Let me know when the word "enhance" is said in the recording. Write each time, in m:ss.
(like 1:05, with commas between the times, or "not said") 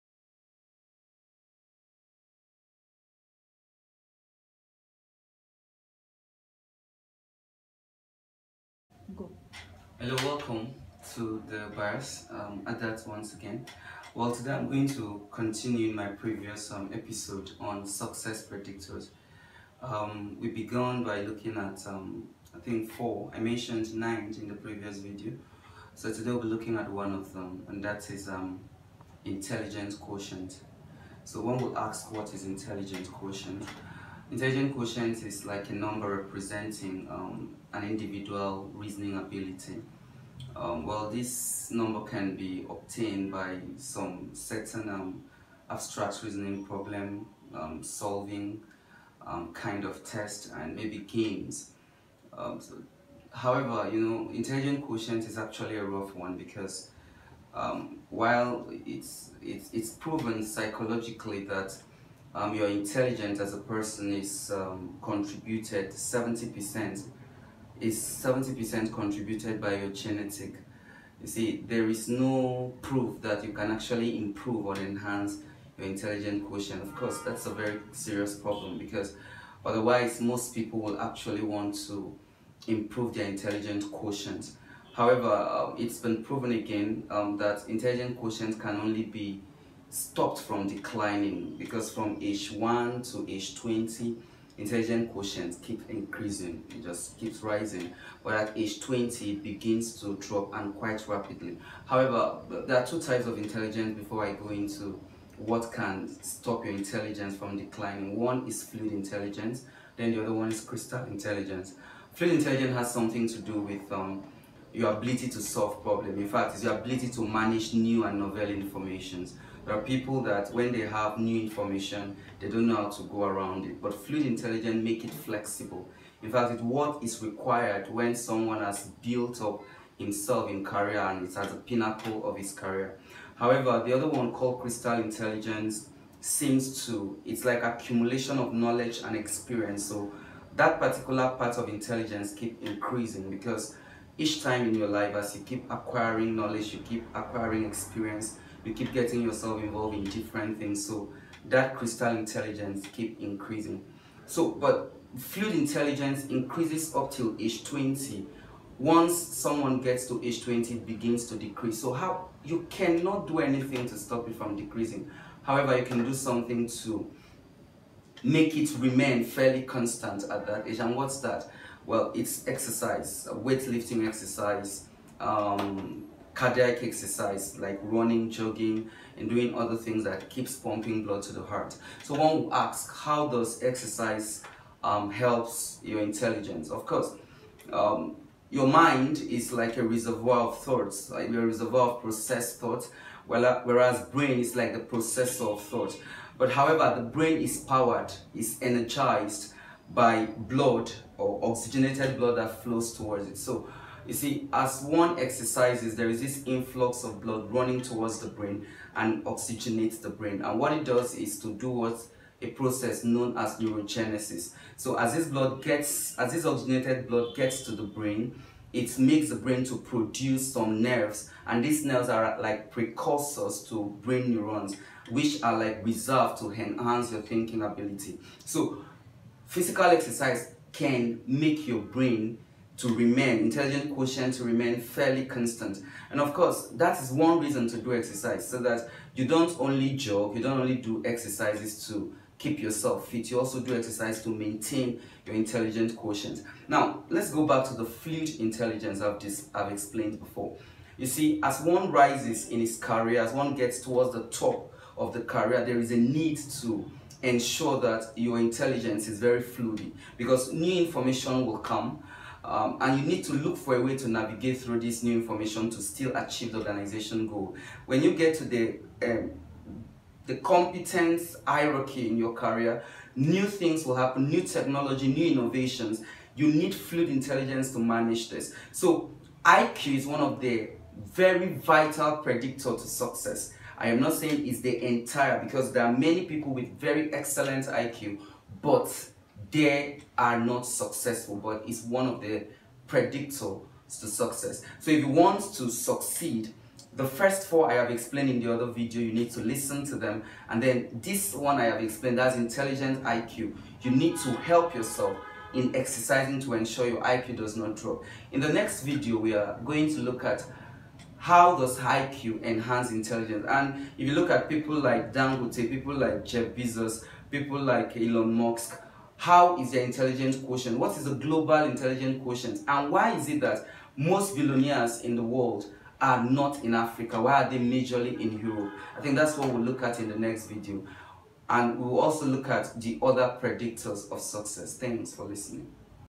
1:14, 3:46, 5:12.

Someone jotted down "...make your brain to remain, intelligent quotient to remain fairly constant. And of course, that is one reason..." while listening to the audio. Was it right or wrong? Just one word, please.
right.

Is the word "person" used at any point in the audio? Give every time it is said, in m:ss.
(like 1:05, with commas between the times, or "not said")
1:03.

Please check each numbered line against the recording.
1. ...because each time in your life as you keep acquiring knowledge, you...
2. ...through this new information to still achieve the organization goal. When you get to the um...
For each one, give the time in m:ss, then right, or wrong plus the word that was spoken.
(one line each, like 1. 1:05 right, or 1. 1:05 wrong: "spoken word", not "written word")
1. 2:23 right
2. 4:24 right.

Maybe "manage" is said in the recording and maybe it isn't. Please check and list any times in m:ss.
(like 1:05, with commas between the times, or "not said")
1:57, 4:37.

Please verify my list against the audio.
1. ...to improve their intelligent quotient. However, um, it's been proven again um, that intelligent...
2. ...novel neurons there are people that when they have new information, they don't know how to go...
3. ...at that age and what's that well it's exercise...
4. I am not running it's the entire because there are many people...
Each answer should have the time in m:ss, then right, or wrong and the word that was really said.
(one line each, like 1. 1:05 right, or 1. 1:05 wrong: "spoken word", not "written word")
1. 1:21 right
2. 1:58 wrong: "informations", not "neurons"
3. 2:50 right
4. 4:43 wrong: "saying", not "running".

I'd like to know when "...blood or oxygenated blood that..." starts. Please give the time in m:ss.
3:20.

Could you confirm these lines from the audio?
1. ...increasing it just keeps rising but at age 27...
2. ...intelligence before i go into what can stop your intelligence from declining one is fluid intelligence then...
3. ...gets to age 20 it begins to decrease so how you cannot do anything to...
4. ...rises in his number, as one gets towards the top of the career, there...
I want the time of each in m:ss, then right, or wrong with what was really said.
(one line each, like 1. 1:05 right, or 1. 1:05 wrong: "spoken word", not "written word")
1. 1:35 wrong: "20", not "27"
2. 1:43 right
3. 2:39 right
4. 4:11 wrong: "career", not "number".